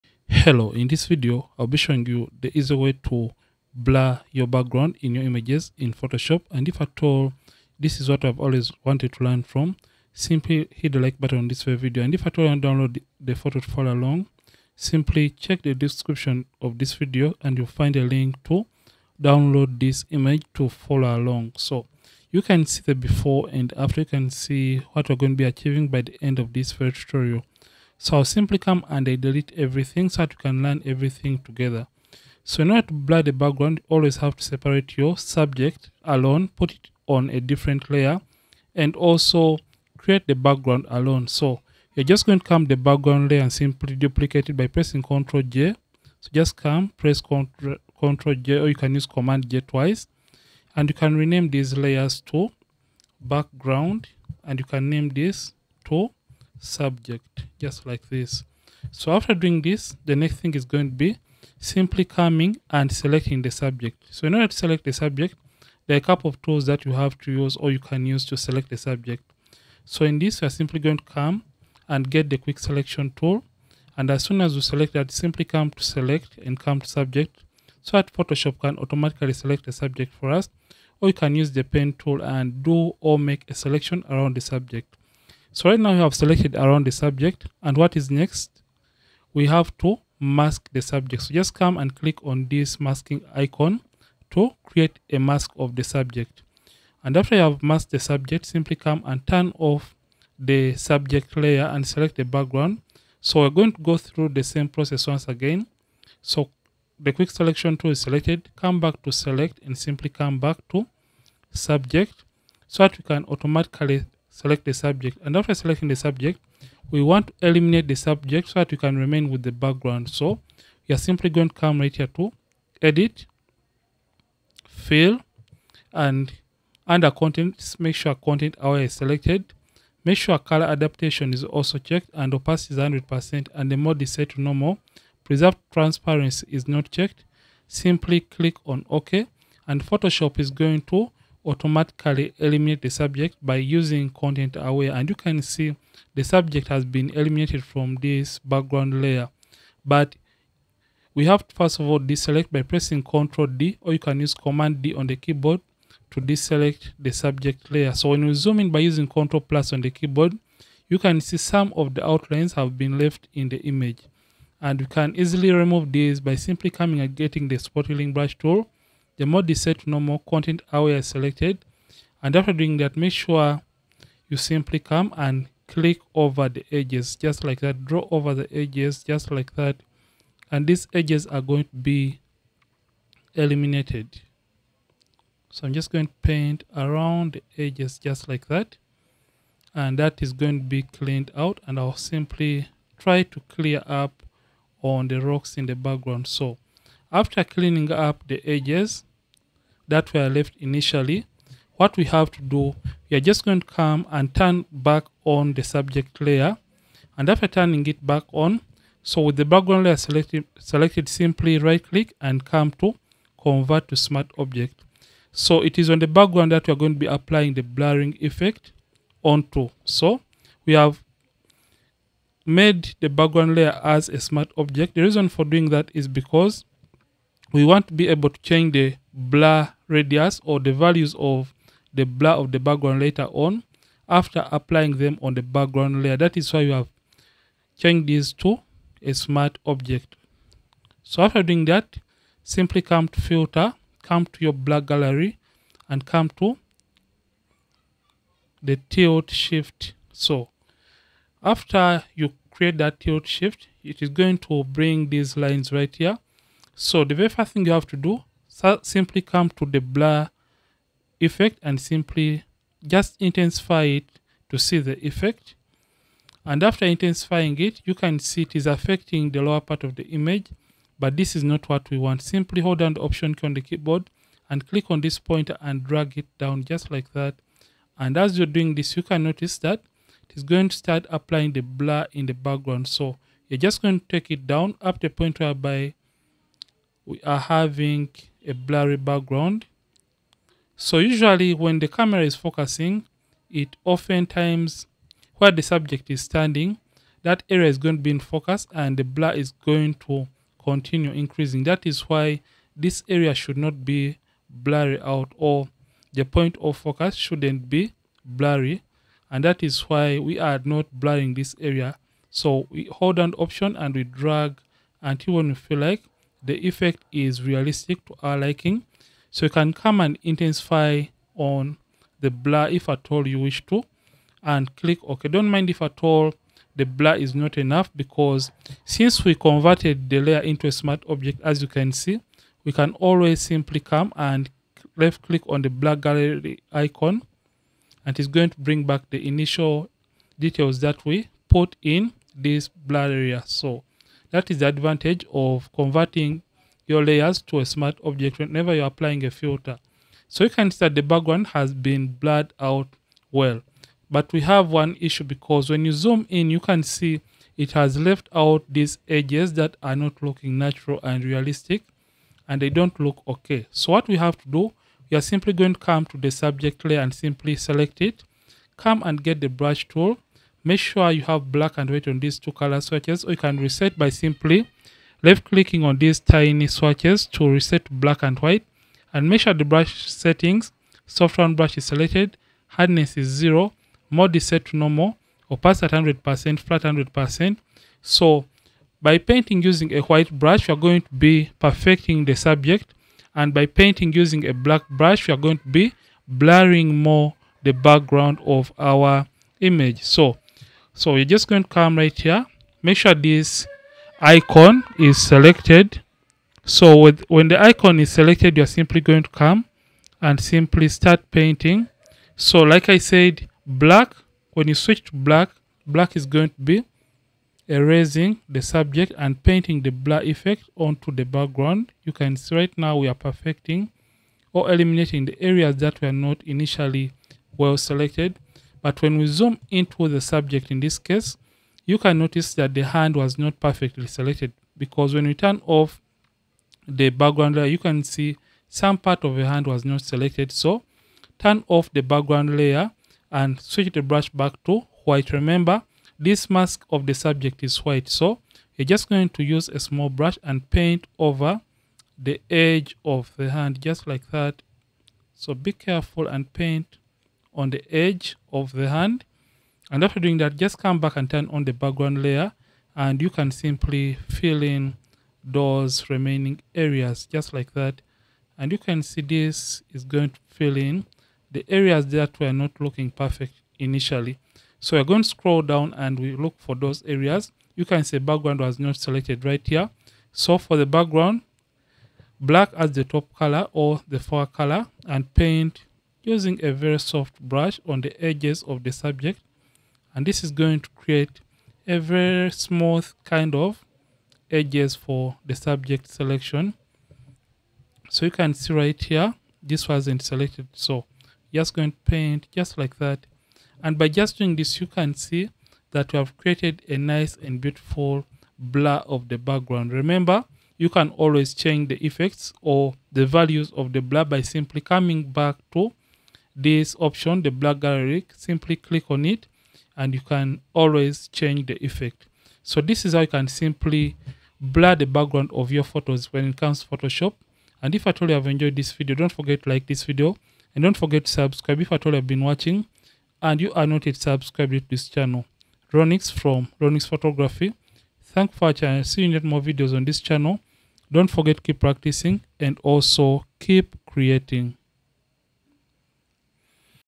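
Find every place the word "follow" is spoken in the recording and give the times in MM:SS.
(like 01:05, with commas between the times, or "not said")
00:13, 00:20.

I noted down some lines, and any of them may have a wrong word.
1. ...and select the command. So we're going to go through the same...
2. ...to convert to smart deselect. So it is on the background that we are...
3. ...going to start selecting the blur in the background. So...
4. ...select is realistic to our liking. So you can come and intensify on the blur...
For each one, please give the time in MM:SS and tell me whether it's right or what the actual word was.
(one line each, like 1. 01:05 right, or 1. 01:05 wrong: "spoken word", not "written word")
1. 01:41 wrong: "background", not "command"
2. 03:32 wrong: "object", not "deselect"
3. 04:40 wrong: "applying", not "selecting"
4. 05:16 wrong: "effect", not "select".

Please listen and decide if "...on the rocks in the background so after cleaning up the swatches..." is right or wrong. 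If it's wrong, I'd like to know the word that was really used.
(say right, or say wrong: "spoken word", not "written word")
wrong: "edges", not "swatches".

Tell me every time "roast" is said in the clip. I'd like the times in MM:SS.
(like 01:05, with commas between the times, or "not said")
not said.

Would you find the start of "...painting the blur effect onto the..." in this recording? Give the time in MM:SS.
06:59.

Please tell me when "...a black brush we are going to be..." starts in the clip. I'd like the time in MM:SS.
06:34.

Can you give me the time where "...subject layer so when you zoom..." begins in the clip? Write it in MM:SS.
02:37.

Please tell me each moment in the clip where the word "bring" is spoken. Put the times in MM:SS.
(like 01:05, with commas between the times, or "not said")
04:14, 05:38.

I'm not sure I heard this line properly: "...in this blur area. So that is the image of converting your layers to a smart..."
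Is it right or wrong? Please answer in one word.
wrong.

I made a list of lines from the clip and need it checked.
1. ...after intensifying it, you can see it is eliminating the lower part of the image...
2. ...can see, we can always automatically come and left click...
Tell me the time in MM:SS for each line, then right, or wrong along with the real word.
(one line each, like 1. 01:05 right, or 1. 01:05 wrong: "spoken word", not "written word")
1. 04:26 wrong: "affecting", not "eliminating"
2. 05:31 wrong: "simply", not "automatically".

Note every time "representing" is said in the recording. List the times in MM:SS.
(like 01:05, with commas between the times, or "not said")
not said.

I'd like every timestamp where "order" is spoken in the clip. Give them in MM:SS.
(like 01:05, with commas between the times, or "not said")
00:32, 01:04.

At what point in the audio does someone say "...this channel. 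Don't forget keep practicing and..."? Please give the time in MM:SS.
09:00.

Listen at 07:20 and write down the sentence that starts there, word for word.
So turn off the background layer and switch the brush back to white.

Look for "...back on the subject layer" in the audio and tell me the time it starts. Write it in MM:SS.
03:24.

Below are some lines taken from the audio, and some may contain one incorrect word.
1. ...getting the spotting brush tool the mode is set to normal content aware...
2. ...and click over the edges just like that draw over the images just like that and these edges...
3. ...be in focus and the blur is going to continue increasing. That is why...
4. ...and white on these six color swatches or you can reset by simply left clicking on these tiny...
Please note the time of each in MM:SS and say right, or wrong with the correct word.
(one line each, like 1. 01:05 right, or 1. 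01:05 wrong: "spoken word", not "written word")
1. 02:47 right
2. 02:55 wrong: "edges", not "images"
3. 04:58 right
4. 06:11 wrong: "two", not "six".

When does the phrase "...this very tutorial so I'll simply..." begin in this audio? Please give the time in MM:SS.
00:26.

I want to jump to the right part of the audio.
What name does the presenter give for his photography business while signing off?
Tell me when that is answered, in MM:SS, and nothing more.
08:56.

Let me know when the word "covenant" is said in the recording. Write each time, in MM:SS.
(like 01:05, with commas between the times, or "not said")
not said.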